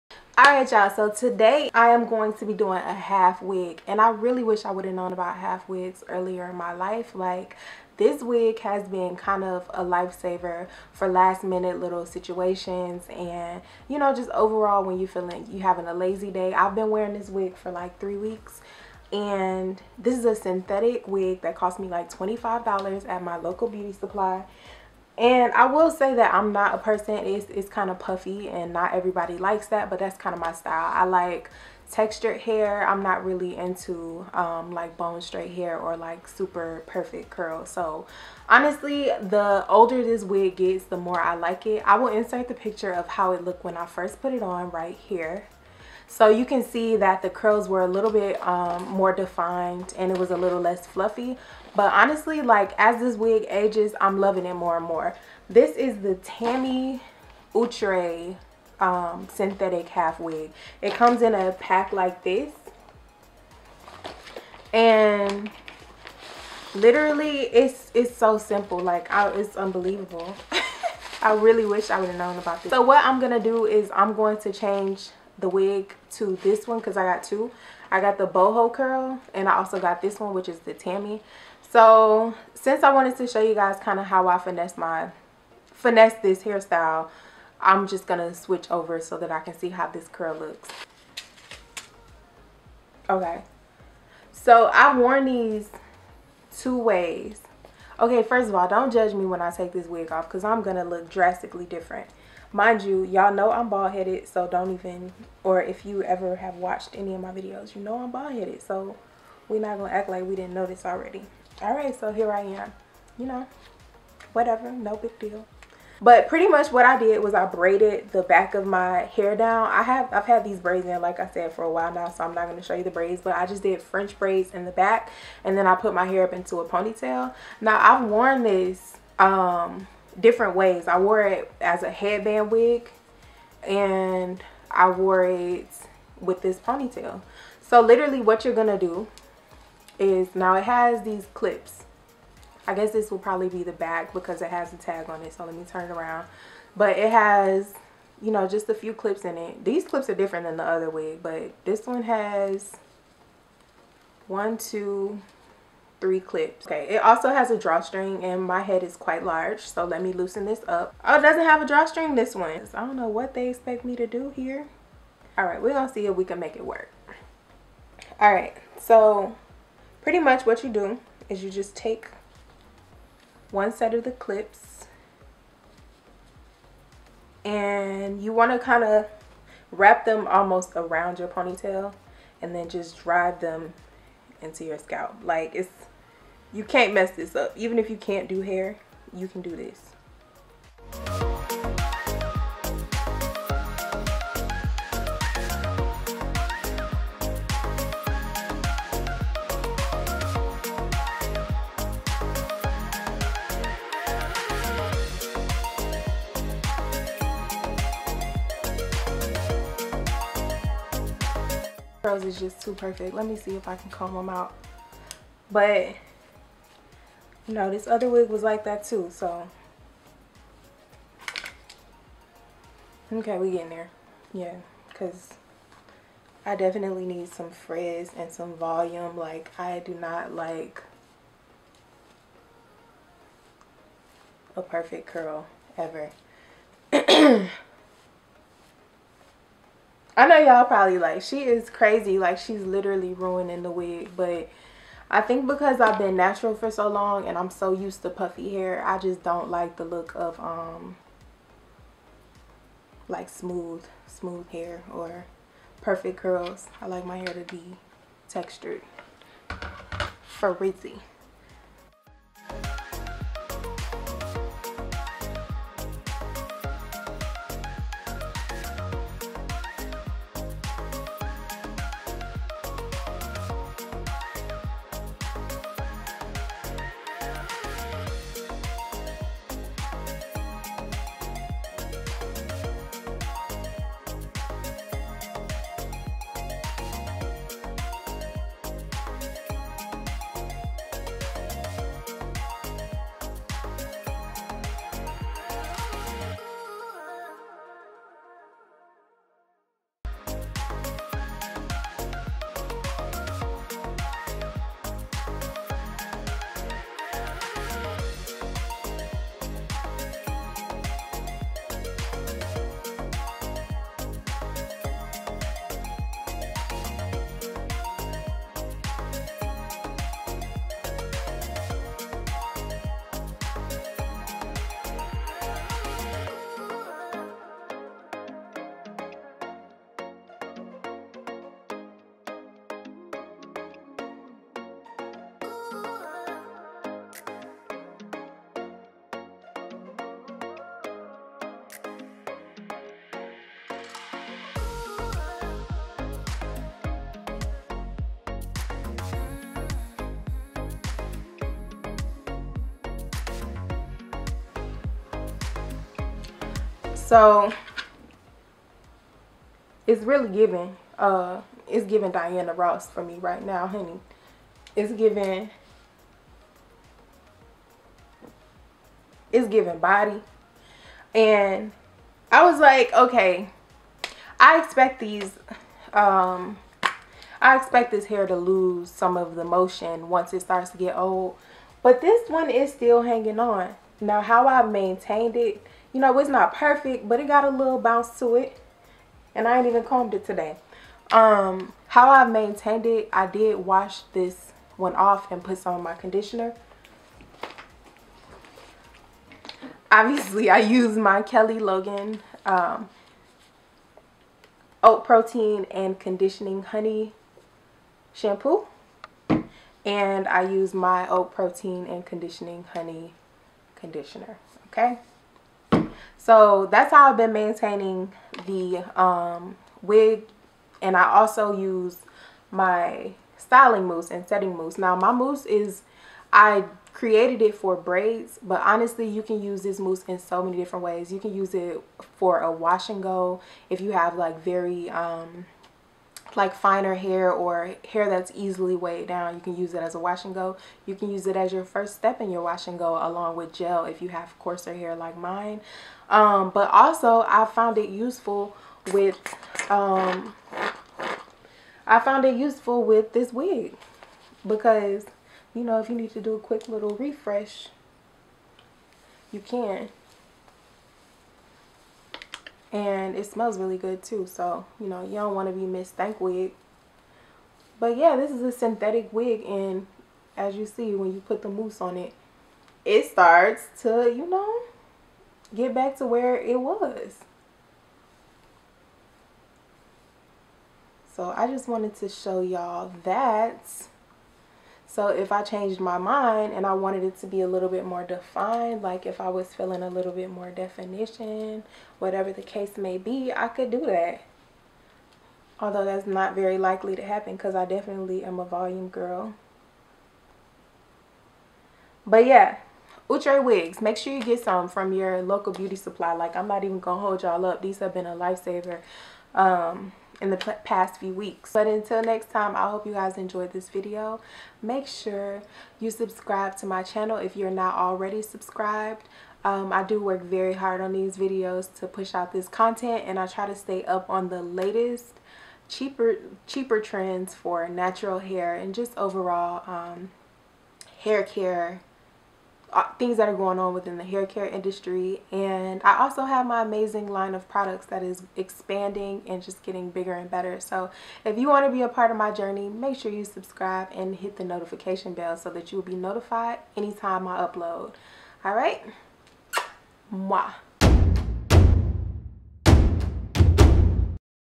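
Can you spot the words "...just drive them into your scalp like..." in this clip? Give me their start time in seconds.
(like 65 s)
182 s.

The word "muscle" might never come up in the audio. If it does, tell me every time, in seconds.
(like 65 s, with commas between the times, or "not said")
not said.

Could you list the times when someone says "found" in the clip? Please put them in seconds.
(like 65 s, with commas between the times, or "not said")
447 s, 451 s.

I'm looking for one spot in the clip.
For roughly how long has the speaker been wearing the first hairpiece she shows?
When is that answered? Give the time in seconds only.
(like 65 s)
17 s.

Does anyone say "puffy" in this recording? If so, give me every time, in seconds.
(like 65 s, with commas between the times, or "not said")
27 s, 248 s.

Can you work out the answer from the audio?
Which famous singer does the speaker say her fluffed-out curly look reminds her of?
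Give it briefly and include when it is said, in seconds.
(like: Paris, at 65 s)
Diana Ross, at 362 s.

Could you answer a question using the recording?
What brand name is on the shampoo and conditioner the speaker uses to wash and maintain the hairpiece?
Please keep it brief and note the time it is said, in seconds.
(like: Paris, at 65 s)
Kelly Logan, at 401 s.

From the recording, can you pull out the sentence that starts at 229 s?
Like, I do not like a perfect curl ever.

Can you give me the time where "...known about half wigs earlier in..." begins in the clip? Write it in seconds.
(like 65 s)
4 s.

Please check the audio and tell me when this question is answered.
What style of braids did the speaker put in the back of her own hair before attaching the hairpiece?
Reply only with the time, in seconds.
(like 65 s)
123 s.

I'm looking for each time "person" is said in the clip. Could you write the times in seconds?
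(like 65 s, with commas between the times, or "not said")
26 s.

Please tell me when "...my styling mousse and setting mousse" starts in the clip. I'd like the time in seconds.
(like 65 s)
422 s.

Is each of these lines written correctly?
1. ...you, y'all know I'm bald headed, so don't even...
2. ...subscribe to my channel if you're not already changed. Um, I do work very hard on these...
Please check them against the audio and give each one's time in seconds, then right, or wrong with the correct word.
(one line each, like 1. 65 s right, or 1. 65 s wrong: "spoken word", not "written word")
1. 102 s right
2. 515 s wrong: "subscribed", not "changed".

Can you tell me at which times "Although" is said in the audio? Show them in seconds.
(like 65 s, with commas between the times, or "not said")
495 s.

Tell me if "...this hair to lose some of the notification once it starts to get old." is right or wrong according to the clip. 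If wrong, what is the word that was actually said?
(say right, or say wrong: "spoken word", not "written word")
wrong: "motion", not "notification".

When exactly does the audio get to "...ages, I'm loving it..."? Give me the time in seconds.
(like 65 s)
53 s.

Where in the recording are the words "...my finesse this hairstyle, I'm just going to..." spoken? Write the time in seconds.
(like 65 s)
84 s.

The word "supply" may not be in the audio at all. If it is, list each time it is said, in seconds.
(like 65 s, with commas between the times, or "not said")
23 s, 505 s.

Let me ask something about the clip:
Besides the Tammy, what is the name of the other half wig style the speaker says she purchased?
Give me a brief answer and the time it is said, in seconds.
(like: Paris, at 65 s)
boho curl, at 78 s.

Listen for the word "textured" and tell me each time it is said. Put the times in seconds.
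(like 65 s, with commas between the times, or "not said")
31 s, 258 s.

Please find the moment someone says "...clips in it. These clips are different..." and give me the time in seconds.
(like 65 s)
148 s.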